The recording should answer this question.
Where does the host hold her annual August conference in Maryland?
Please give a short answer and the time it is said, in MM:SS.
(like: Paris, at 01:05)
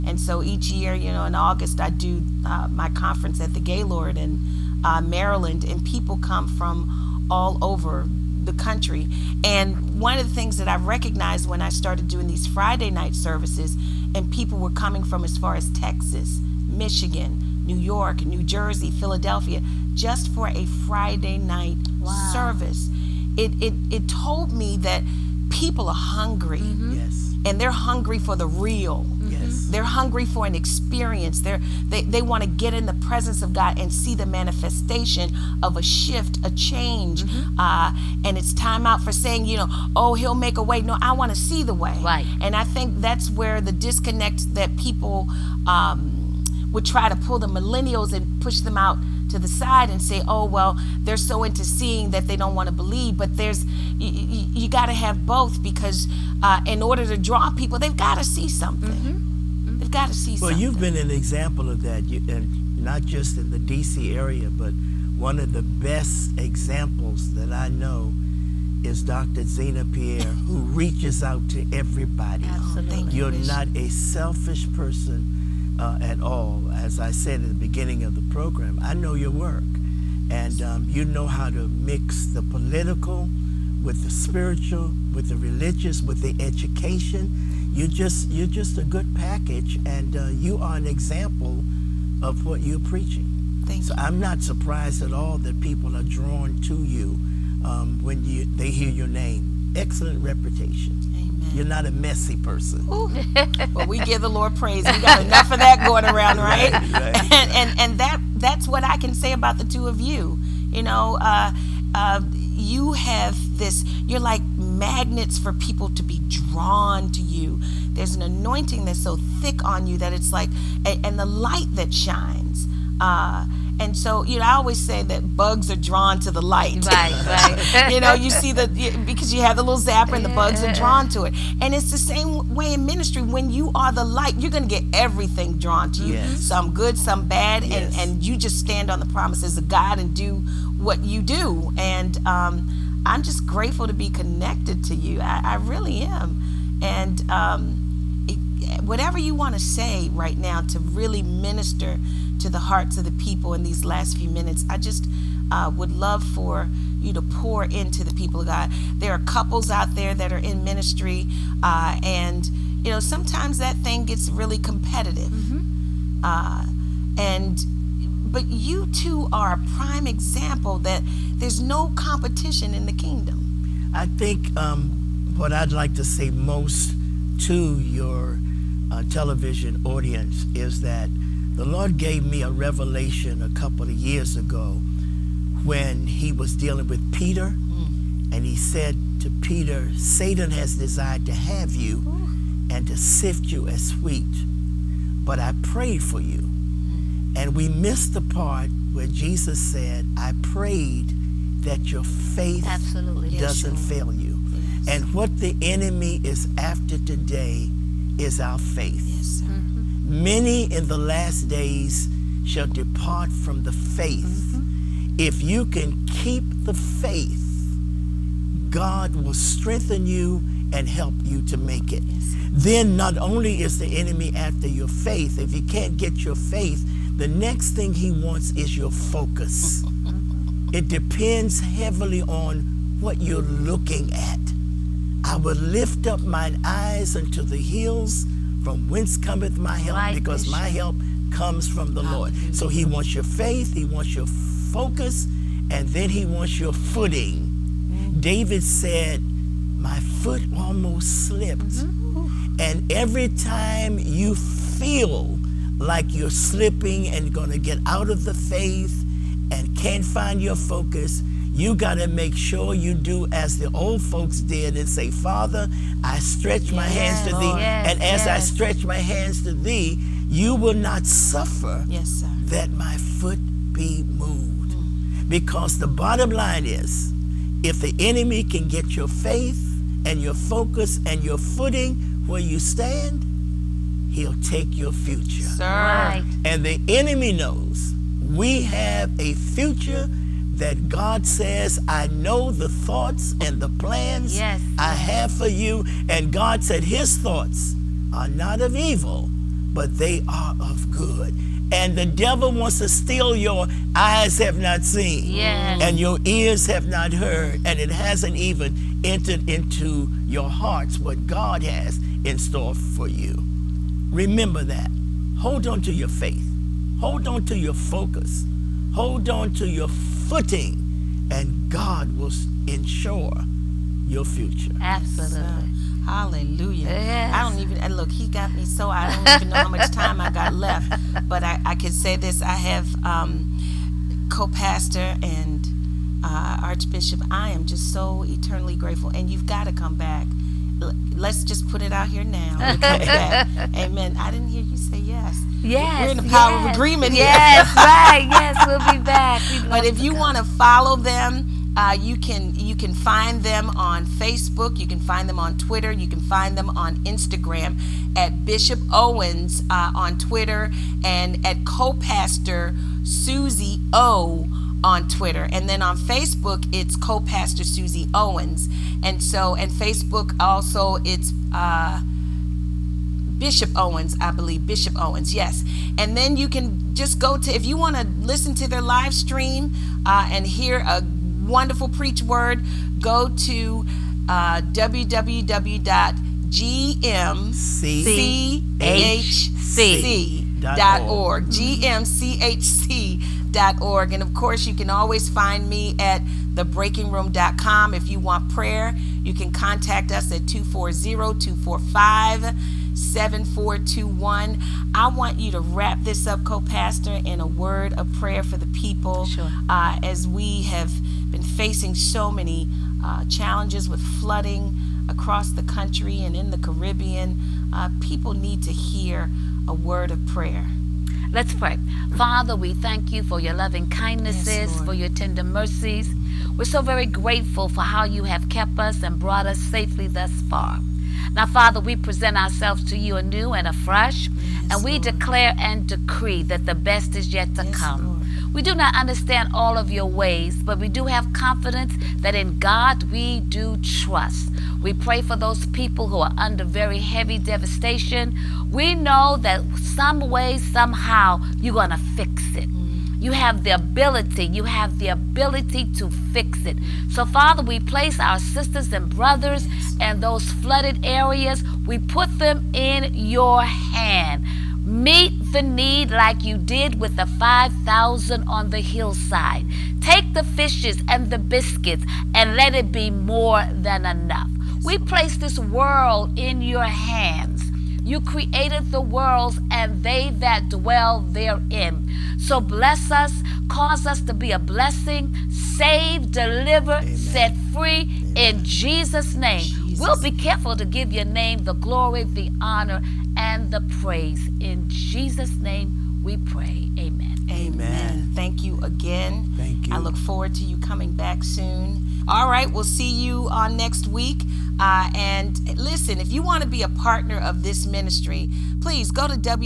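The Gaylord, at 00:03.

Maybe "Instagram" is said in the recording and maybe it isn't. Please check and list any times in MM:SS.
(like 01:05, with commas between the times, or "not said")
05:57.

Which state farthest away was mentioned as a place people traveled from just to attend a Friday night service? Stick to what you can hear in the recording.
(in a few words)
Texas.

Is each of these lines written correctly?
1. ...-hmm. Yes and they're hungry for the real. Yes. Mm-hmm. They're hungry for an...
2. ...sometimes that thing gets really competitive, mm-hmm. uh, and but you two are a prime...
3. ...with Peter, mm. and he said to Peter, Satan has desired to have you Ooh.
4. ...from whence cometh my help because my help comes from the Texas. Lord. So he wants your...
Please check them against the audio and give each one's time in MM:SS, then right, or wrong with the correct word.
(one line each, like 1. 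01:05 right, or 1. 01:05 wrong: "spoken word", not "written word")
1. 00:26 right
2. 02:43 right
3. 03:06 right
4. 03:58 wrong: "Hallelujah", not "Texas".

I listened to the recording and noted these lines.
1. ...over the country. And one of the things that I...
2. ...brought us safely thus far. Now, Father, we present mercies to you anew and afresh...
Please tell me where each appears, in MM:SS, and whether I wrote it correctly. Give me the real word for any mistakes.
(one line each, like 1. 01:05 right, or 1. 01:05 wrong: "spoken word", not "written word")
1. 00:07 right
2. 07:09 wrong: "ourselves", not "mercies".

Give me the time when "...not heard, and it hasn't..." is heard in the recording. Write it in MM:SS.
05:06.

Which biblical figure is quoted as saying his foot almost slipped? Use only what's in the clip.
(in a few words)
David.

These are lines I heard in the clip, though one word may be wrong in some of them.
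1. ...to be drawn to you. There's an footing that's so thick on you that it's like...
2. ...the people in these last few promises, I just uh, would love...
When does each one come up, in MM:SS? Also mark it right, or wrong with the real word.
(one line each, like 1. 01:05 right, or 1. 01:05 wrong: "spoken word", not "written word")
1. 01:55 wrong: "anointing", not "footing"
2. 02:33 wrong: "minutes", not "promises".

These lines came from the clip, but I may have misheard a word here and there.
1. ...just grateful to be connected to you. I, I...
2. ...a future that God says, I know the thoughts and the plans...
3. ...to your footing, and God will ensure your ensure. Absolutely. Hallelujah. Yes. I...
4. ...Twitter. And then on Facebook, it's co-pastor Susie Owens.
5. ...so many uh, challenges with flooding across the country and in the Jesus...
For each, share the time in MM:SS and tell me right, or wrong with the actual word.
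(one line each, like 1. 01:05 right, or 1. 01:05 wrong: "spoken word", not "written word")
1. 02:23 right
2. 04:49 right
3. 05:19 wrong: "future", not "ensure"
4. 06:05 right
5. 06:51 wrong: "Caribbean", not "Jesus".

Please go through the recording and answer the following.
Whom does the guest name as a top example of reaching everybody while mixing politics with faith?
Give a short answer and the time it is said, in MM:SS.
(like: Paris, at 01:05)
Dr. Zina Pierre, at 01:09.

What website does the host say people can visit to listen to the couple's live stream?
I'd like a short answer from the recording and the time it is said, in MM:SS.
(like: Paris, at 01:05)
gmchc.org, at 06:24.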